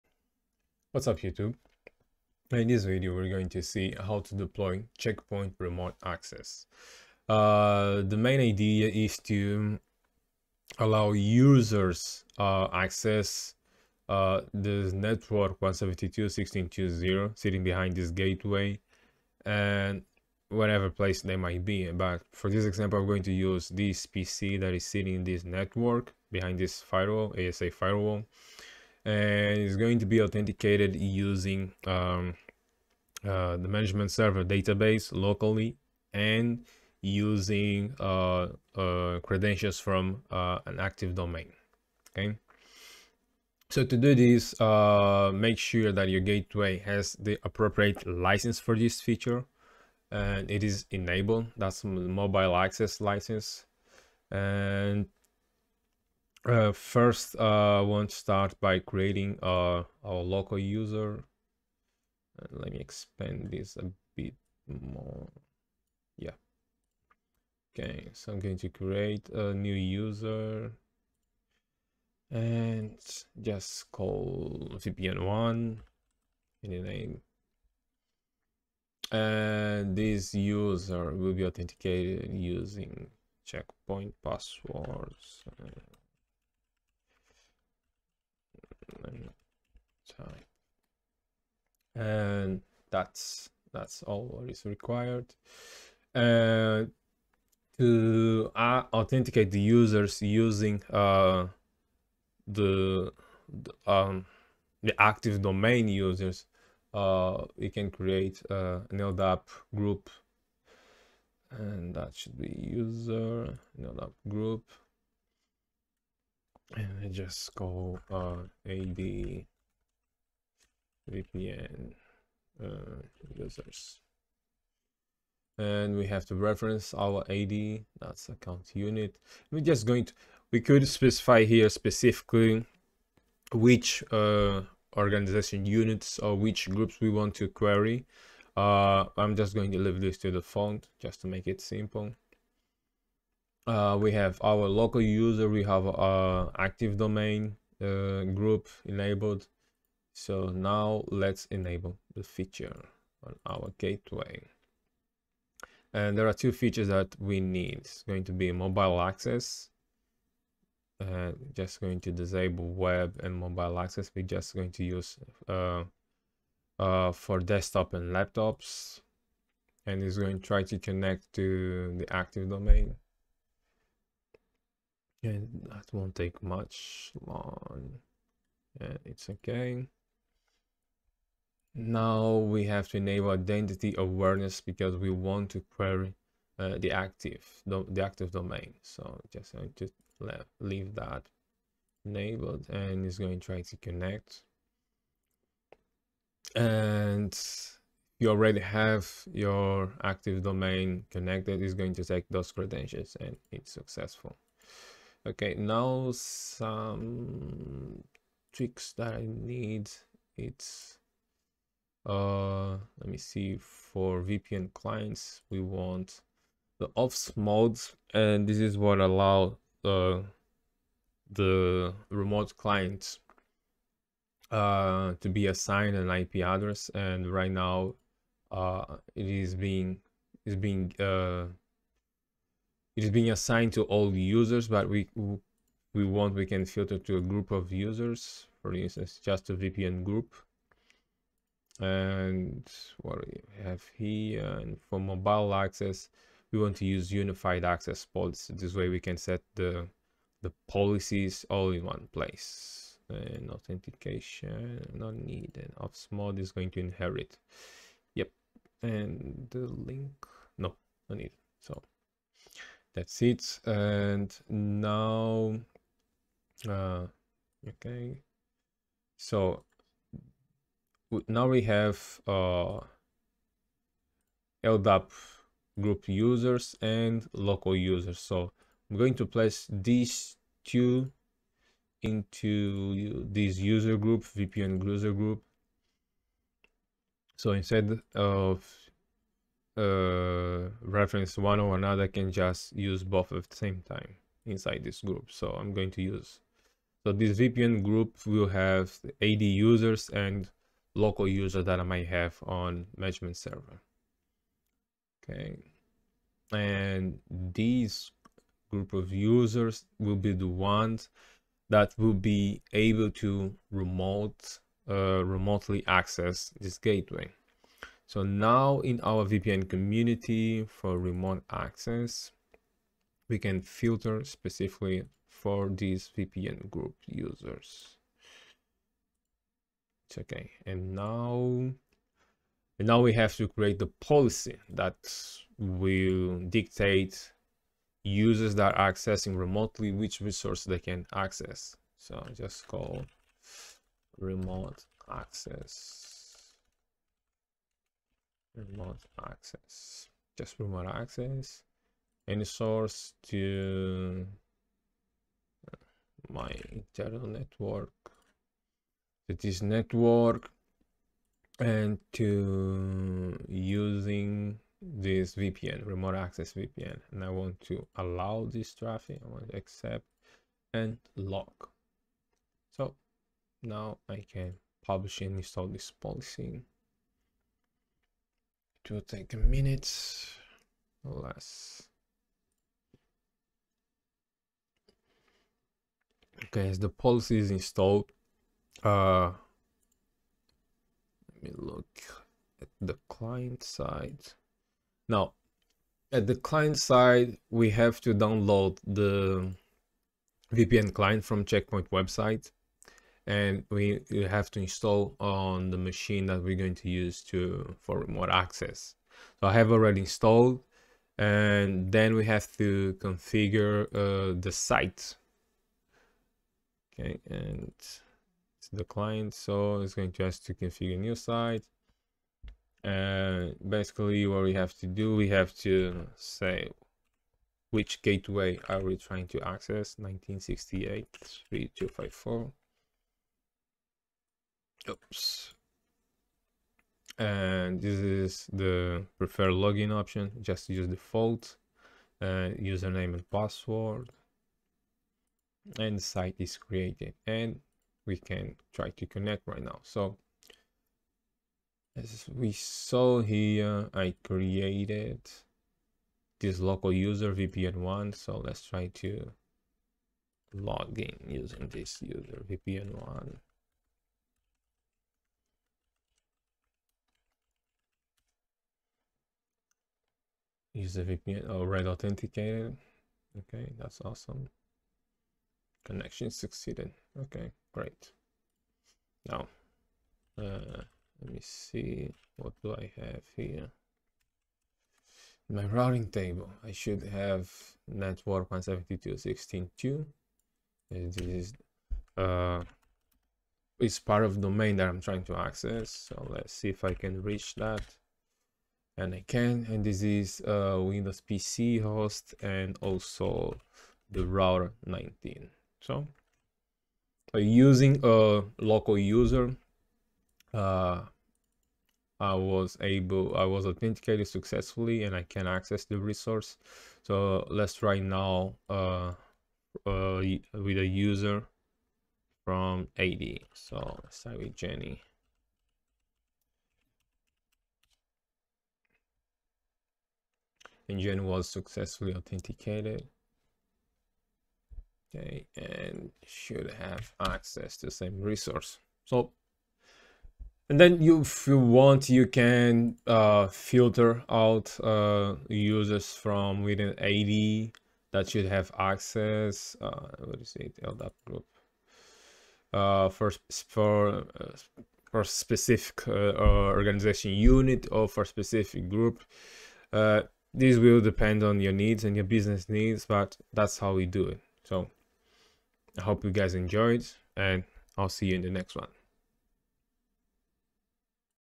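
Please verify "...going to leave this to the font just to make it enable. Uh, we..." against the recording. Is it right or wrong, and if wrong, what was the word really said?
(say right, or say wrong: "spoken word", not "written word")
wrong: "simple", not "enable".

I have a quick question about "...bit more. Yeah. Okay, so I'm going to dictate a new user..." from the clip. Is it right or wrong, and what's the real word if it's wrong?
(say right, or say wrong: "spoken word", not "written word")
wrong: "create", not "dictate".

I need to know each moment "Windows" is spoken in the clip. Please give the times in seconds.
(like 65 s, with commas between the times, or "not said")
500 s.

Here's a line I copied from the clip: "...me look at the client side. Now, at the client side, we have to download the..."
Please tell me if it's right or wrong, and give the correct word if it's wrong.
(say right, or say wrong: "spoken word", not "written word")
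right.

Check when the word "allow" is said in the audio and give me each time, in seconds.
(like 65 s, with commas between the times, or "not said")
10 s, 218 s, 367 s.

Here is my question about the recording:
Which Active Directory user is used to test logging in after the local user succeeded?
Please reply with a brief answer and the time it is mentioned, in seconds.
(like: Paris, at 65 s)
Jenny, at 524 s.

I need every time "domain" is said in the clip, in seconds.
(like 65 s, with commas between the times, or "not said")
41 s, 105 s, 146 s, 172 s, 188 s, 200 s, 494 s.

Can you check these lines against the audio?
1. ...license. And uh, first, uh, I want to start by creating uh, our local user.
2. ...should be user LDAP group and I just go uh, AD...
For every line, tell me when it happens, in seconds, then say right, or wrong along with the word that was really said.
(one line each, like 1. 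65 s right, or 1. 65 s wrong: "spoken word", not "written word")
1. 52 s right
2. 112 s right.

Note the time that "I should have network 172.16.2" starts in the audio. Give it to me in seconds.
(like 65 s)
486 s.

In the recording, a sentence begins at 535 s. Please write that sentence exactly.
Okay, and should have access to the same resource.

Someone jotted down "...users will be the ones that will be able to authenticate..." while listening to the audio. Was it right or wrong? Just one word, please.
wrong.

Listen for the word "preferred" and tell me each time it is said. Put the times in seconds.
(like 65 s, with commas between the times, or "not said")
439 s.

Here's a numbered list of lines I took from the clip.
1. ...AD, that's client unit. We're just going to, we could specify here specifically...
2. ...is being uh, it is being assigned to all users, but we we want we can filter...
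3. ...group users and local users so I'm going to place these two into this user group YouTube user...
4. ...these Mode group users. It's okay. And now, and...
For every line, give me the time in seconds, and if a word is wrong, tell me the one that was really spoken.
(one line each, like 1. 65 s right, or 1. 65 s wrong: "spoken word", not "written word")
1. 127 s wrong: "account", not "client"
2. 230 s right
3. 275 s wrong: "VPN", not "YouTube"
4. 325 s wrong: "VPN", not "Mode".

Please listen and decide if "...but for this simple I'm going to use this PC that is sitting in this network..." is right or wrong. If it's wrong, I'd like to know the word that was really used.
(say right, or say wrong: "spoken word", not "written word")
wrong: "example", not "simple".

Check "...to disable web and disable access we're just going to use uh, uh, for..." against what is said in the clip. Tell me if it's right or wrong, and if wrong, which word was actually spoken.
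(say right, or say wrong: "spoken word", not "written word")
wrong: "mobile", not "disable".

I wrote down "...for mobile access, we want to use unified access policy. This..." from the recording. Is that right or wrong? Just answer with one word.
right.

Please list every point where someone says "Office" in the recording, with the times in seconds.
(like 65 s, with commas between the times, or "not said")
216 s, 255 s.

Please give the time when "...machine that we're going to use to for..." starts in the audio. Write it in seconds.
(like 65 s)
405 s.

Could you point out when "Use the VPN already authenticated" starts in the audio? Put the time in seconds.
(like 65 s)
470 s.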